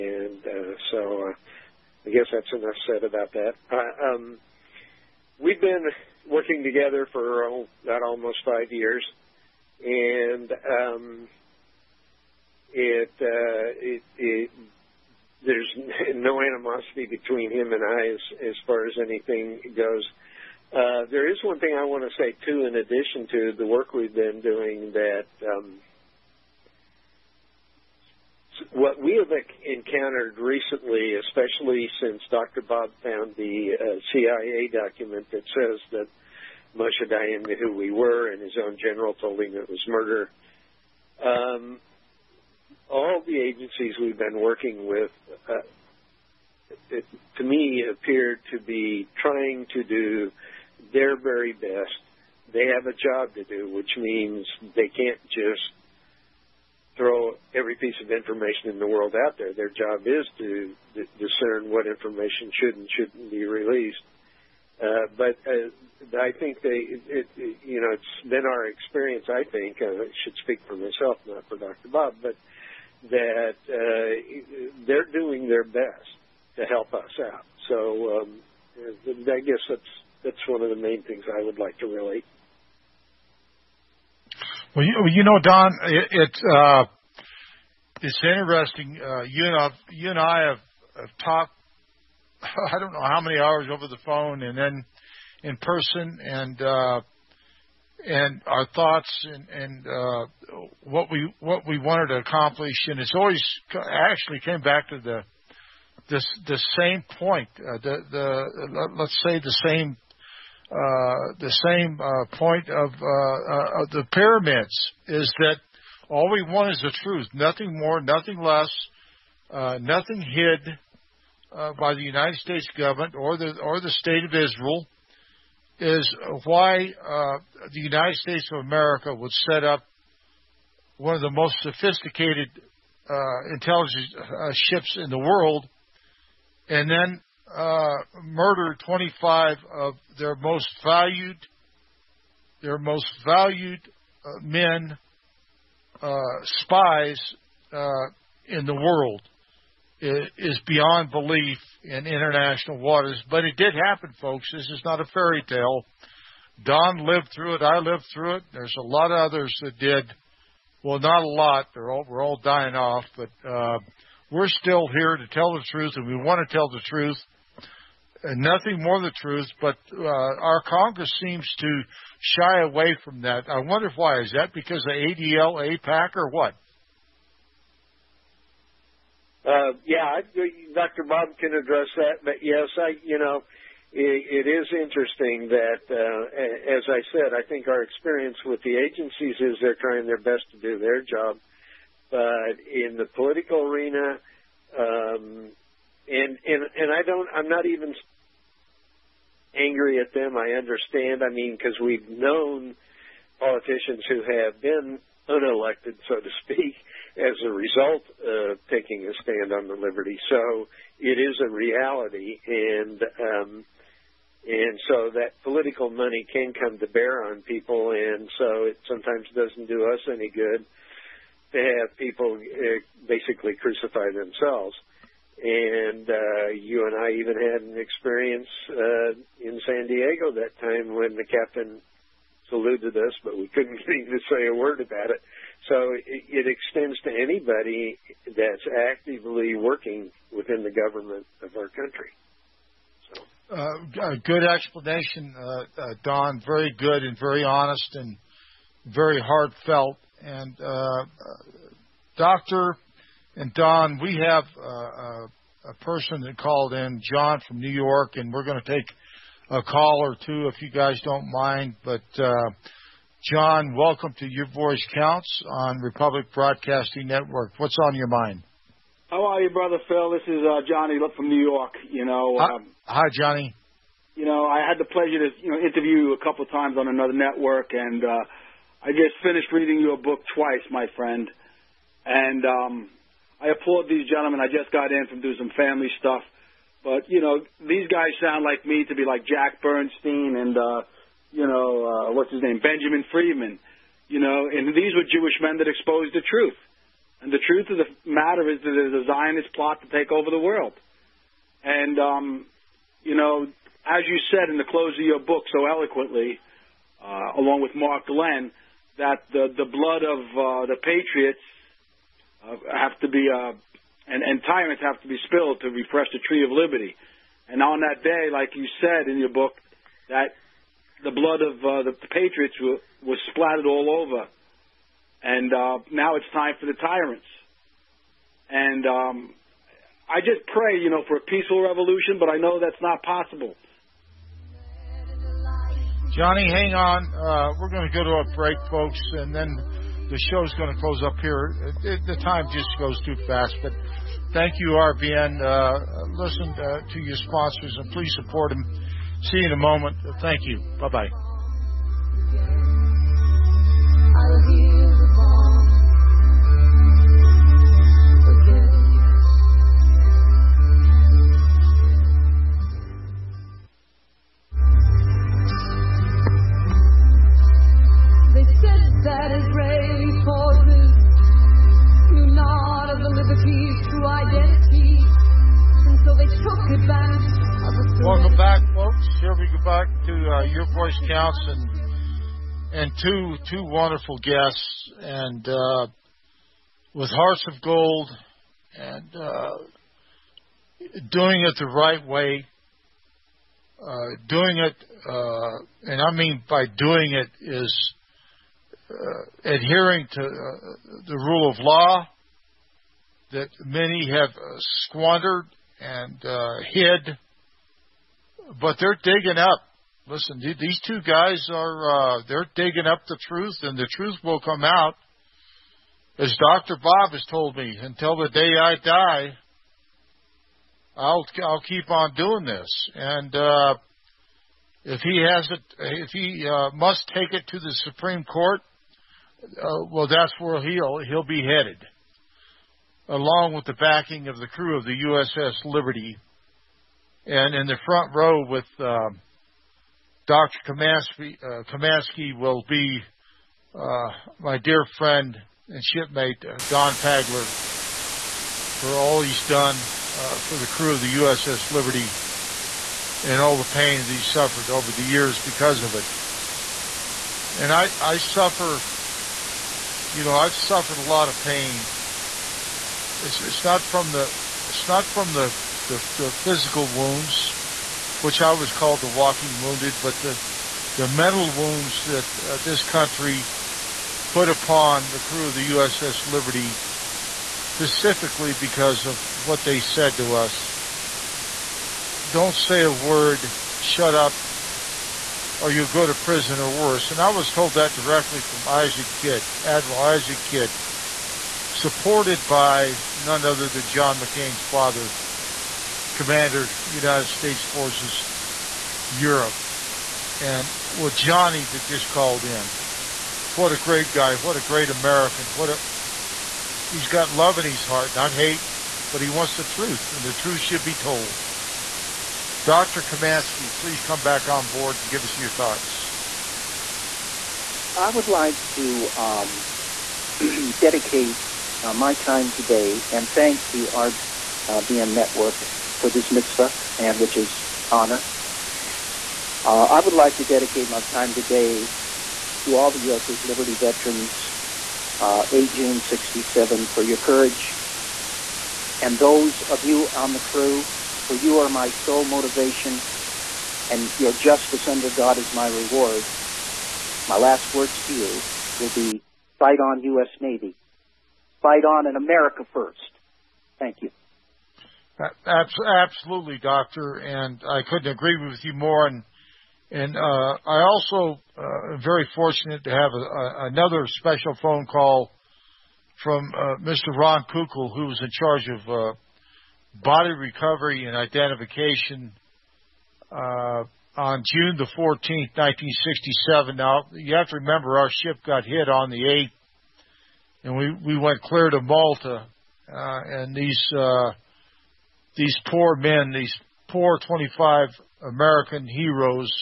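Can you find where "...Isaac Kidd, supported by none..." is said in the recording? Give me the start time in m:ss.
8:10.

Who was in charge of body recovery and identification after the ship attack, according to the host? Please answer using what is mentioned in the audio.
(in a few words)
Ron Kukal.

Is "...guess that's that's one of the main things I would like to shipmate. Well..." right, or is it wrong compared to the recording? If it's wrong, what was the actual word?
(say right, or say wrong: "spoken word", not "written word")
wrong: "relate", not "shipmate".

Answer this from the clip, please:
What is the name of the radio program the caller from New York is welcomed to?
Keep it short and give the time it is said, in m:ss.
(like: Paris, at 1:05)
Your Voice Counts, at 4:24.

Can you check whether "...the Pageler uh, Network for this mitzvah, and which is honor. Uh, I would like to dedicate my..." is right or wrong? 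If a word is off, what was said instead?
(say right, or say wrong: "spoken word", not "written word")
wrong: "RBN", not "Pageler".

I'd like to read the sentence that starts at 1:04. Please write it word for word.
Uh, but uh, I think they, it, it, you know, it's been our experience.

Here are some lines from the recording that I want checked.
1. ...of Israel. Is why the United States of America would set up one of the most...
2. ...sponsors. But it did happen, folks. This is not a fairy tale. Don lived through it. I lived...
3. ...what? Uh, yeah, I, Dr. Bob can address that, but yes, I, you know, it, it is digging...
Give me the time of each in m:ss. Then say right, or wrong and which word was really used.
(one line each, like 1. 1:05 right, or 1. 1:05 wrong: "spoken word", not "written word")
1. 2:04 right
2. 2:32 wrong: "waters", not "sponsors"
3. 2:56 wrong: "interesting", not "digging".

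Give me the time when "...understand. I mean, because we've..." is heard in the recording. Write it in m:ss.
3:20.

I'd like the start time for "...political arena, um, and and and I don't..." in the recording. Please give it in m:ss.
3:13.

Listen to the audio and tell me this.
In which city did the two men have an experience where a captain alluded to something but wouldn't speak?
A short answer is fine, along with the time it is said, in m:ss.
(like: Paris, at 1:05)
San Diego, at 3:49.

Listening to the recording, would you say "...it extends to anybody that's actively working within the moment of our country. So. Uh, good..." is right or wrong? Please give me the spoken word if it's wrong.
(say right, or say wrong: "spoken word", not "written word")
wrong: "government", not "moment".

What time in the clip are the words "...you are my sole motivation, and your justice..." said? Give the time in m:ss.
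9:01.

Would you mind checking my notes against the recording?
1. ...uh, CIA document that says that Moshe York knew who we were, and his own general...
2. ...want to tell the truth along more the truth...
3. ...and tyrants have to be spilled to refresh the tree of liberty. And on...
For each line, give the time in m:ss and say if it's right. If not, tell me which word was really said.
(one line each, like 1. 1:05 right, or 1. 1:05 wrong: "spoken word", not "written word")
1. 0:33 wrong: "Dayan", not "York"
2. 2:46 wrong: "nothing", not "along"
3. 5:14 right.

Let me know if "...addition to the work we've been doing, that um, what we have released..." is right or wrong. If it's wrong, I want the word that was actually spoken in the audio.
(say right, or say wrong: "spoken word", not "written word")
wrong: "encountered", not "released".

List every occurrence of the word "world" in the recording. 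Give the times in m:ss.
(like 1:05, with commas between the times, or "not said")
0:58, 2:15, 2:28, 5:00.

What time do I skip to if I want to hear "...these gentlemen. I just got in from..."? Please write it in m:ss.
4:43.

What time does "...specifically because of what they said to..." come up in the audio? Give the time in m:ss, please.
7:57.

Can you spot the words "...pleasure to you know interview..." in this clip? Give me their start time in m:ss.
4:34.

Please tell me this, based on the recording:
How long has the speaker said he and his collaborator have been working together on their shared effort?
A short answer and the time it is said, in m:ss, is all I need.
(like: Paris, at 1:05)
almost 5 years, at 0:08.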